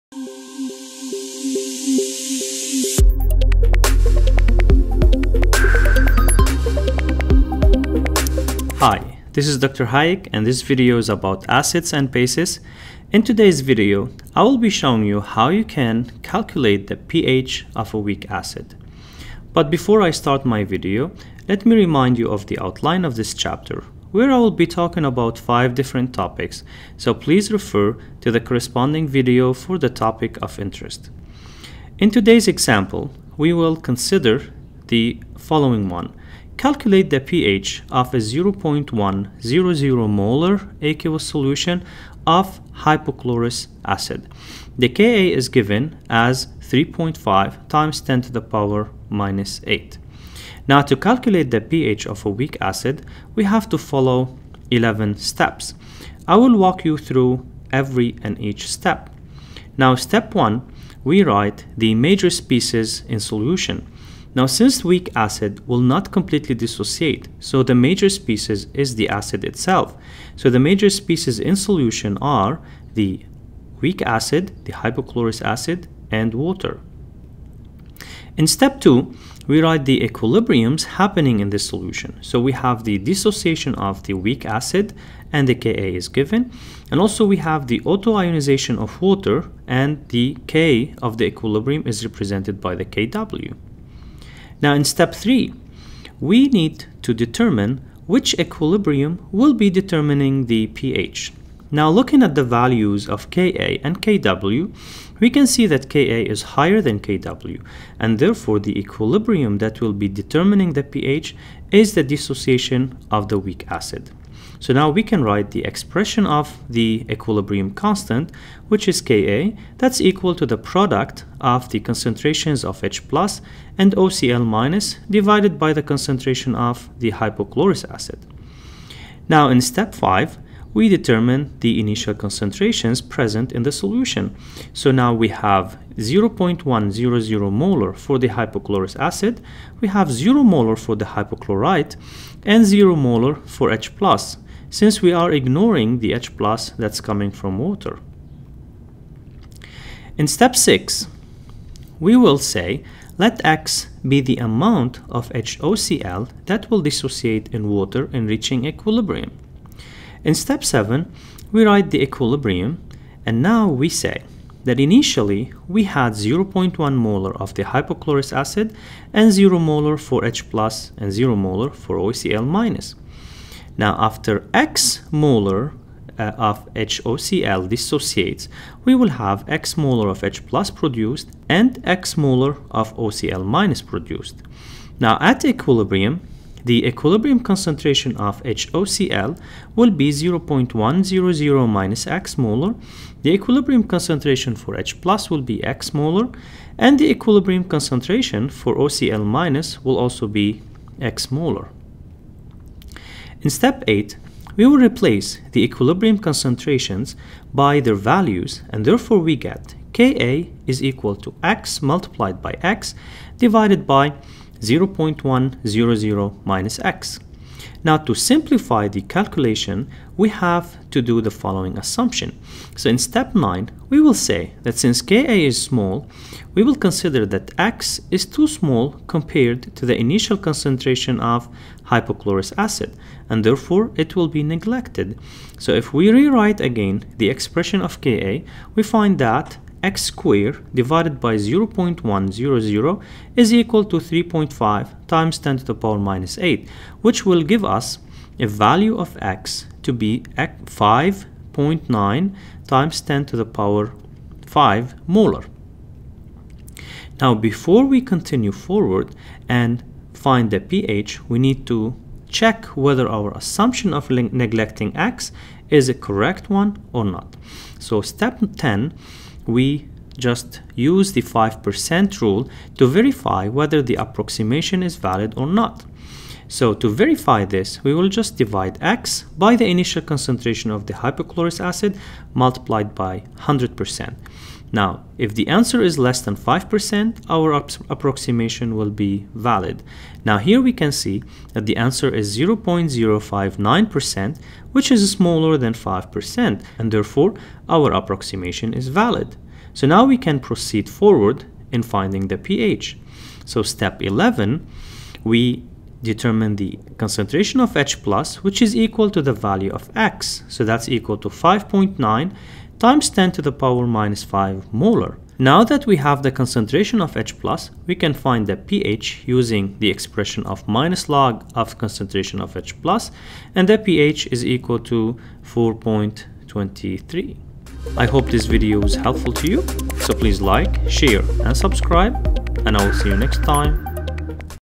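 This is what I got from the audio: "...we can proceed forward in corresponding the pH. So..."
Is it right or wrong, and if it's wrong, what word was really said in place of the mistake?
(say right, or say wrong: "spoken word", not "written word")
wrong: "finding", not "corresponding".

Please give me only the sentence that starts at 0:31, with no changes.
In today's example, we will consider the following one, Calculate the pH of a 0.100 molar aqueous solution of hypochlorous acid.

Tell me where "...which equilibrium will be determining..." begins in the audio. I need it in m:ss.
1:38.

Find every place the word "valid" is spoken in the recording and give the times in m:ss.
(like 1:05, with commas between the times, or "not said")
4:34, 4:49, 4:58.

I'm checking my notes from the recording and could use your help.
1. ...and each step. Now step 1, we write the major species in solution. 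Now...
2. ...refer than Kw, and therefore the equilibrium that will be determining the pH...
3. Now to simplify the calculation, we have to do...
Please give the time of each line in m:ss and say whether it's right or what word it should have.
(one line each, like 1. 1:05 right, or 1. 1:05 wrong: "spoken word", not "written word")
1. 0:58 right
2. 1:46 wrong: "higher", not "refer"
3. 3:37 right.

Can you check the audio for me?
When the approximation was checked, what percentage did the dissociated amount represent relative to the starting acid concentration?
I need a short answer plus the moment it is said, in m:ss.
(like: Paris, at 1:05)
0.059%, at 4:52.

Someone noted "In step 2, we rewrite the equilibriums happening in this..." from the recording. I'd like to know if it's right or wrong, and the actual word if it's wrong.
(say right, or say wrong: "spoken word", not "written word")
wrong: "write", not "rewrite".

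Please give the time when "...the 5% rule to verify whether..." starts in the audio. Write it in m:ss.
4:31.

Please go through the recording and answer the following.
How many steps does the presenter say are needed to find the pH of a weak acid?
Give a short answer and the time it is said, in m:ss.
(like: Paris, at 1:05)
11, at 0:54.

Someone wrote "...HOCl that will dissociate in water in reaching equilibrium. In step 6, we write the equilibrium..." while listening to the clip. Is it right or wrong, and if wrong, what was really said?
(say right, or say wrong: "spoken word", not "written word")
wrong: "7", not "6".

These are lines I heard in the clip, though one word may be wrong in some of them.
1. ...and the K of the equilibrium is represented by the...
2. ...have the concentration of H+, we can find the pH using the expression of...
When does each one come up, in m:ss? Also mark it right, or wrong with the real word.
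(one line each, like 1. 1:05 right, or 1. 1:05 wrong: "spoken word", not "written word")
1. 1:29 right
2. 5:15 right.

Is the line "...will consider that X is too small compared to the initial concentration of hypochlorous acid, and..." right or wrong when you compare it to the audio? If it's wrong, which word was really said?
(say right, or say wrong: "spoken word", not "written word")
right.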